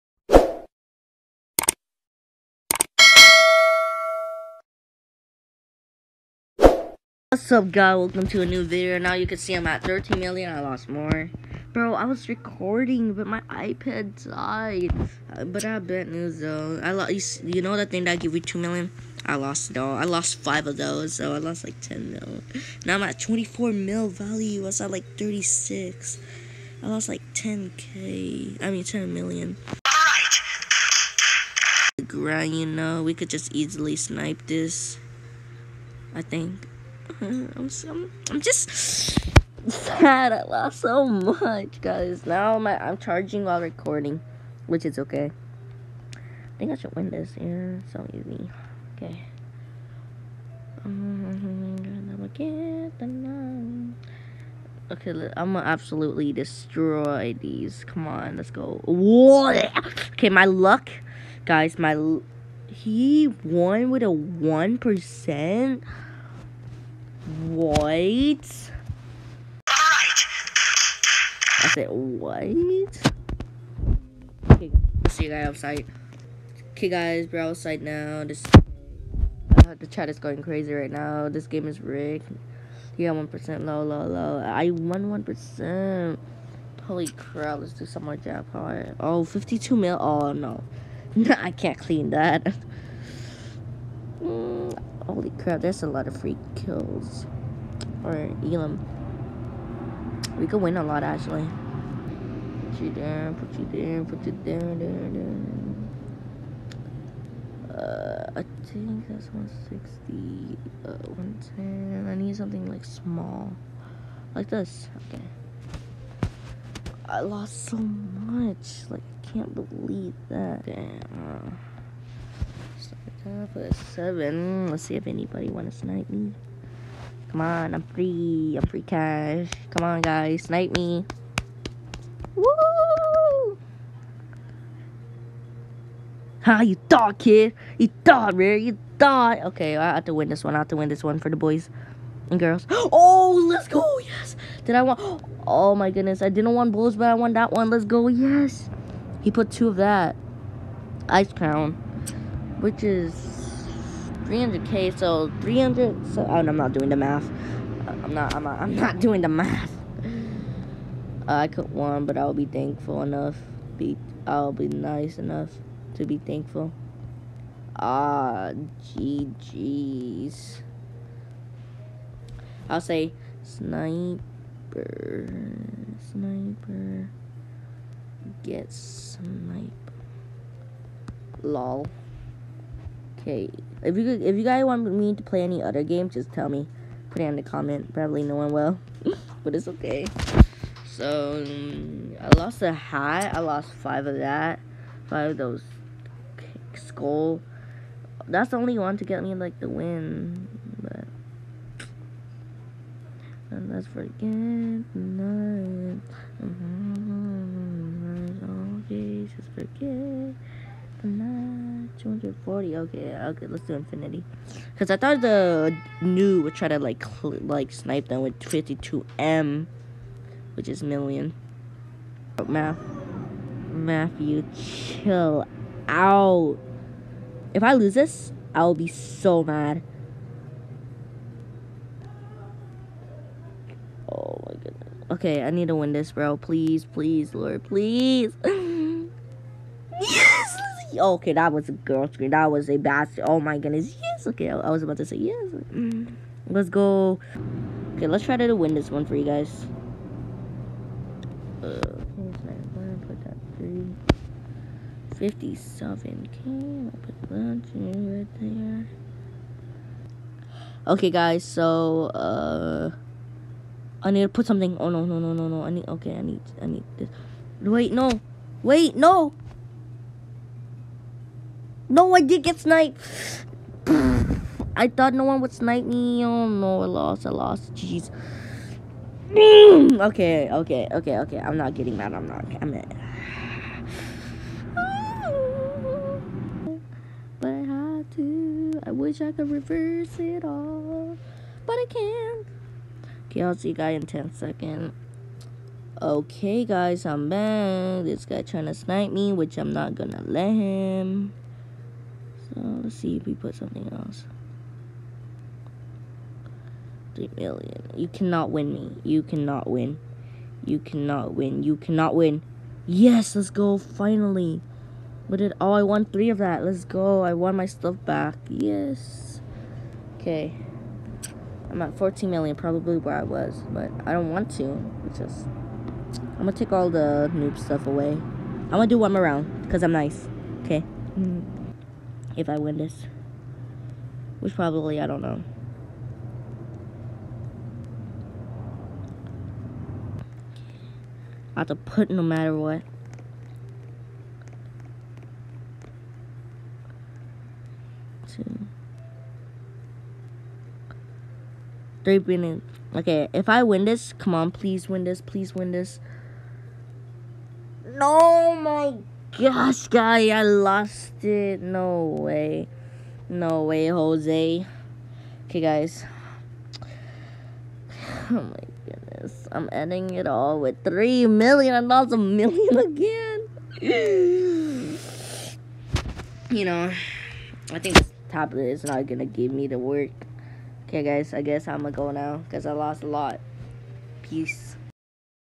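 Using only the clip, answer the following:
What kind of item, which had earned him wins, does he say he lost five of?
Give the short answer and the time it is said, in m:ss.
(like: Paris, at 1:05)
skull, at 3:16.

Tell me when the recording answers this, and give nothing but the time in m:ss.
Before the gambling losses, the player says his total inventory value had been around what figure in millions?
0:25.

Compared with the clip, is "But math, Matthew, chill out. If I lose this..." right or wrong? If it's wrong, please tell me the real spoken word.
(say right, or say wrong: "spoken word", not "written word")
right.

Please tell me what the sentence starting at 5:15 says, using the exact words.
What did, oh, I won three of that.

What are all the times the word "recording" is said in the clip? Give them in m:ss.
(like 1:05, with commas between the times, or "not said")
0:12, 0:43.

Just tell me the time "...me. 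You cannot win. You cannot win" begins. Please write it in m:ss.
5:08.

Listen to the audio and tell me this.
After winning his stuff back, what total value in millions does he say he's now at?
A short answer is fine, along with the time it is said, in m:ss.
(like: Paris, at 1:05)
14 million, at 5:21.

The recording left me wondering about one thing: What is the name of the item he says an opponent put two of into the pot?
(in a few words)
Ice crown.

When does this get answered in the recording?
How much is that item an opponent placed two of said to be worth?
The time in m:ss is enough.
2:34.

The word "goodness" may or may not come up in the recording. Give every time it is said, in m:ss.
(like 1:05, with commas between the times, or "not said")
2:25, 3:54, 4:03, 6:08.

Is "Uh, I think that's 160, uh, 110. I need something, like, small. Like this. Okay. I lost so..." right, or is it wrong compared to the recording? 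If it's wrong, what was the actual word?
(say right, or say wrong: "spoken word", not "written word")
right.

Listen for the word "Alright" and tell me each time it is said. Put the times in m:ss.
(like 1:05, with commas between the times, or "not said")
1:07.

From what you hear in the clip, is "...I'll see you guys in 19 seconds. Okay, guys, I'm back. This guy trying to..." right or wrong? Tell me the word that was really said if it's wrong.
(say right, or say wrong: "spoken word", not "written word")
wrong: "10", not "19".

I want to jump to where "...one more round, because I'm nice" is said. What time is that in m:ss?
5:28.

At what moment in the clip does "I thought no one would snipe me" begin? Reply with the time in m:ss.
4:34.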